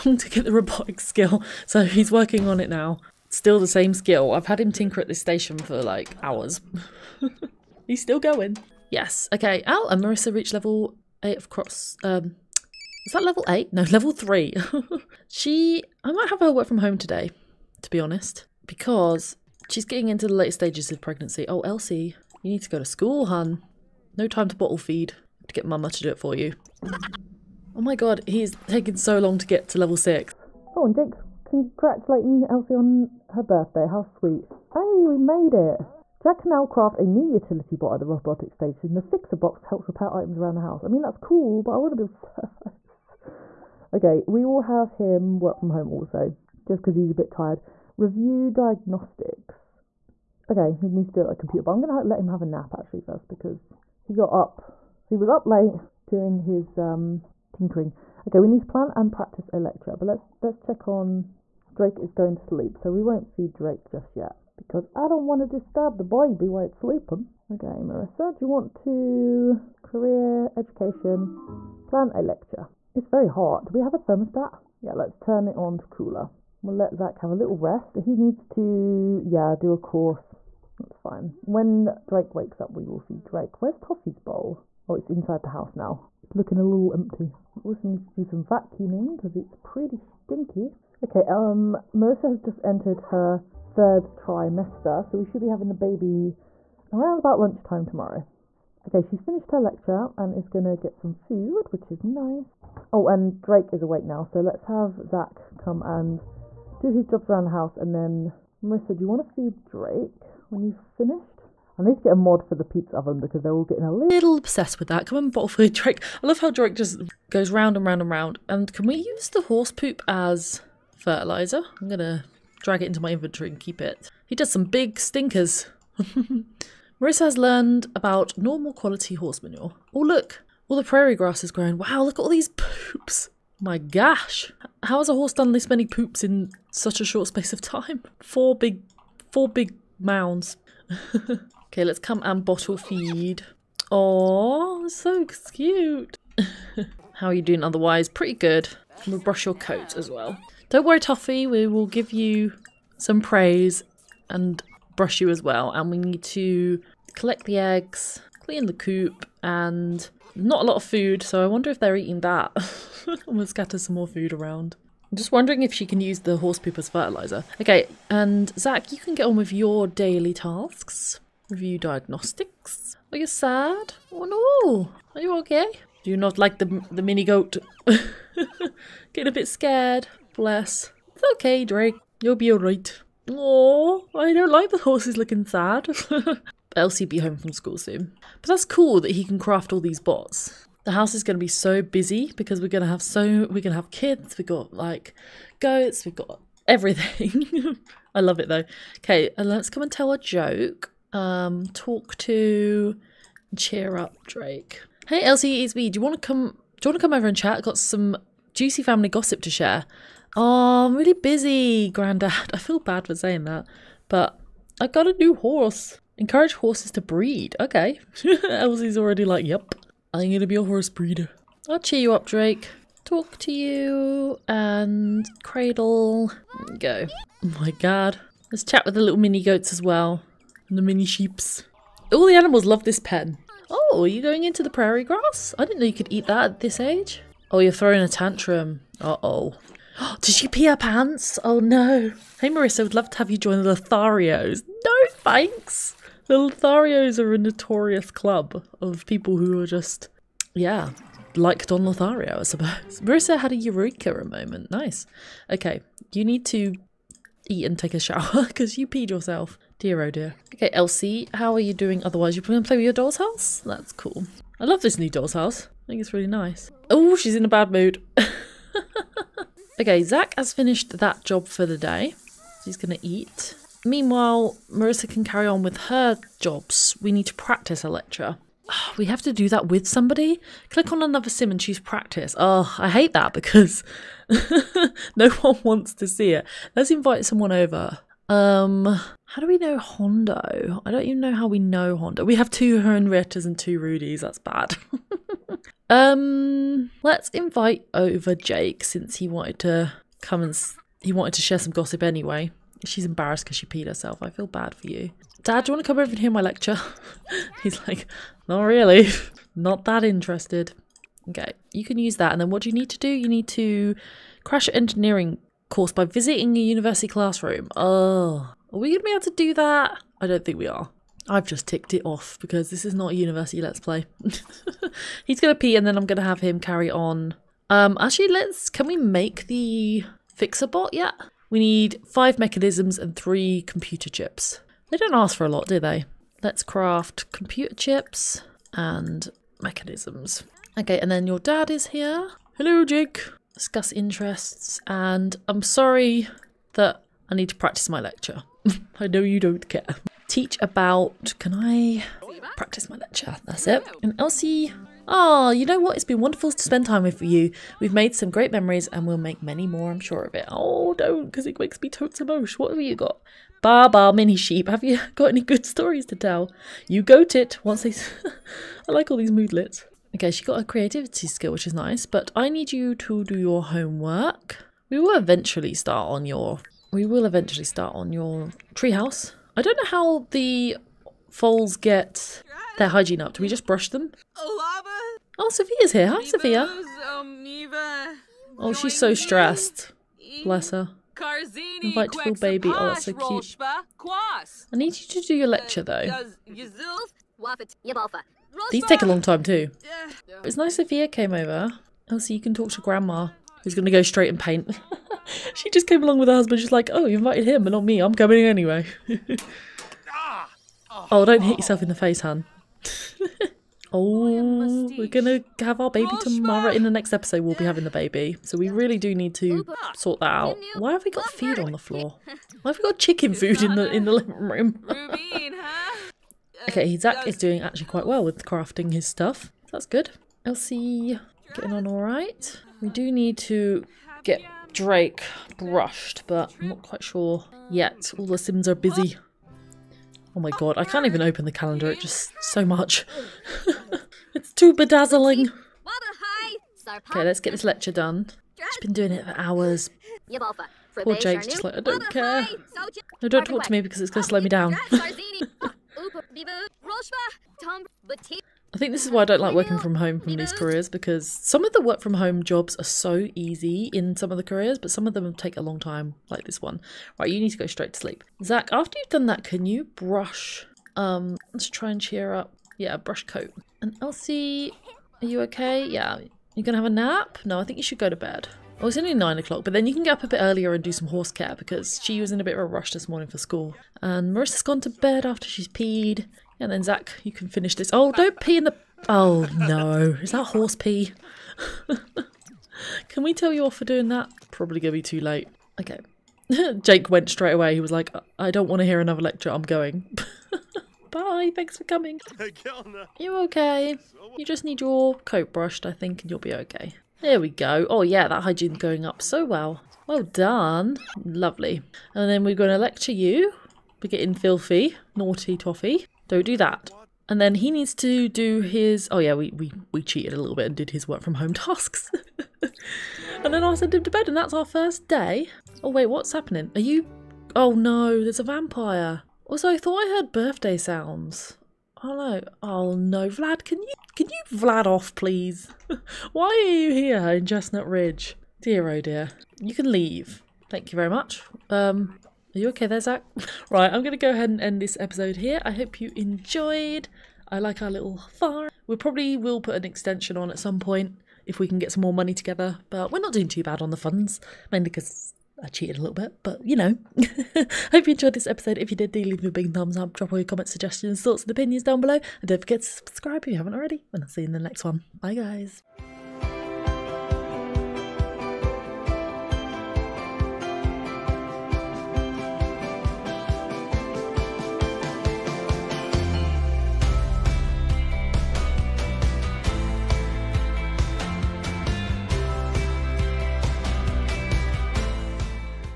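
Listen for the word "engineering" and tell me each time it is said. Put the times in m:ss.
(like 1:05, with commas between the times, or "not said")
5:14.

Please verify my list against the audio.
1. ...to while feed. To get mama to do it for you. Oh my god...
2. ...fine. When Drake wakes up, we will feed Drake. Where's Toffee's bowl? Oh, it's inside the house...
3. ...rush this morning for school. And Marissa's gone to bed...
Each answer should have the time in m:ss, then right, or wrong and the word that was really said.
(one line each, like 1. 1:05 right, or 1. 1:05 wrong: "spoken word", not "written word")
1. 0:24 wrong: "bottle", not "while"
2. 1:20 right
3. 8:02 right.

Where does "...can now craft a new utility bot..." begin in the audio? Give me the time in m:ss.
0:36.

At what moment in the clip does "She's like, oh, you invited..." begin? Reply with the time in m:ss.
6:46.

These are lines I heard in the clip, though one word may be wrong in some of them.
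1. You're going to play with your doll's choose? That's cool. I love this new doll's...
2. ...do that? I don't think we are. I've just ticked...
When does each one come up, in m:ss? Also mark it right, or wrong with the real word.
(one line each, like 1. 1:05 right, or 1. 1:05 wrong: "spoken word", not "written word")
1. 4:22 wrong: "house", not "choose"
2. 5:19 right.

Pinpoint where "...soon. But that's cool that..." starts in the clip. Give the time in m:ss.
3:07.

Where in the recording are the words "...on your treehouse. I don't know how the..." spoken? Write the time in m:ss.
6:17.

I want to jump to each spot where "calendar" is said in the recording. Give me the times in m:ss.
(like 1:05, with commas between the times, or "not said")
7:21.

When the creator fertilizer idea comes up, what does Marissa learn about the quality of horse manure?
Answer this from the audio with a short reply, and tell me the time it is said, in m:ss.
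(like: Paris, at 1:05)
Normal quality, at 2:08.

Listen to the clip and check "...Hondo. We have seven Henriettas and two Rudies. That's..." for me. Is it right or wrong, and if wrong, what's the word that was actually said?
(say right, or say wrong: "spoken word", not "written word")
wrong: "two", not "seven".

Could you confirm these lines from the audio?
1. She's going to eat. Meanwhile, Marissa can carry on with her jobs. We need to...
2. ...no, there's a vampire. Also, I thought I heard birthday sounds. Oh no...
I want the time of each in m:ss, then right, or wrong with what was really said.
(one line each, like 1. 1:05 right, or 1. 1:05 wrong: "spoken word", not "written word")
1. 4:32 right
2. 8:47 right.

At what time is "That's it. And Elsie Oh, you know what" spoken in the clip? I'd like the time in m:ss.
5:53.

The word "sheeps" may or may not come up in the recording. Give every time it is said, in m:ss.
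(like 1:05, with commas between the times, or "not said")
3:51, 6:04.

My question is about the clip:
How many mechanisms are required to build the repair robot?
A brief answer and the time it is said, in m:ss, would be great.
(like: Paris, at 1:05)
5, at 5:32.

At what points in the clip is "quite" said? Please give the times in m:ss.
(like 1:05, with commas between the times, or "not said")
7:07, 7:16.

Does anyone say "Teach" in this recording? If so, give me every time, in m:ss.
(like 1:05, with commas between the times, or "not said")
5:50.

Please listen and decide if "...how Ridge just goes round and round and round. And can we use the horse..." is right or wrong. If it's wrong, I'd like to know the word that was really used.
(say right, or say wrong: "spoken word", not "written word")
wrong: "Drake", not "Ridge".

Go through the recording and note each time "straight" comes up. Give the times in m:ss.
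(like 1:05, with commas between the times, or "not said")
6:44, 7:47, 8:17.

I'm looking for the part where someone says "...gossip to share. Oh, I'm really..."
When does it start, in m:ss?
3:29.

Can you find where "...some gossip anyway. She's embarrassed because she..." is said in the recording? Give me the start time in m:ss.
5:01.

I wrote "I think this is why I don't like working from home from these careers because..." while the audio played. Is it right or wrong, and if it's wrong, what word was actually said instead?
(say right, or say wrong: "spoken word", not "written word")
right.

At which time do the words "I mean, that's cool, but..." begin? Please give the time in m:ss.
0:40.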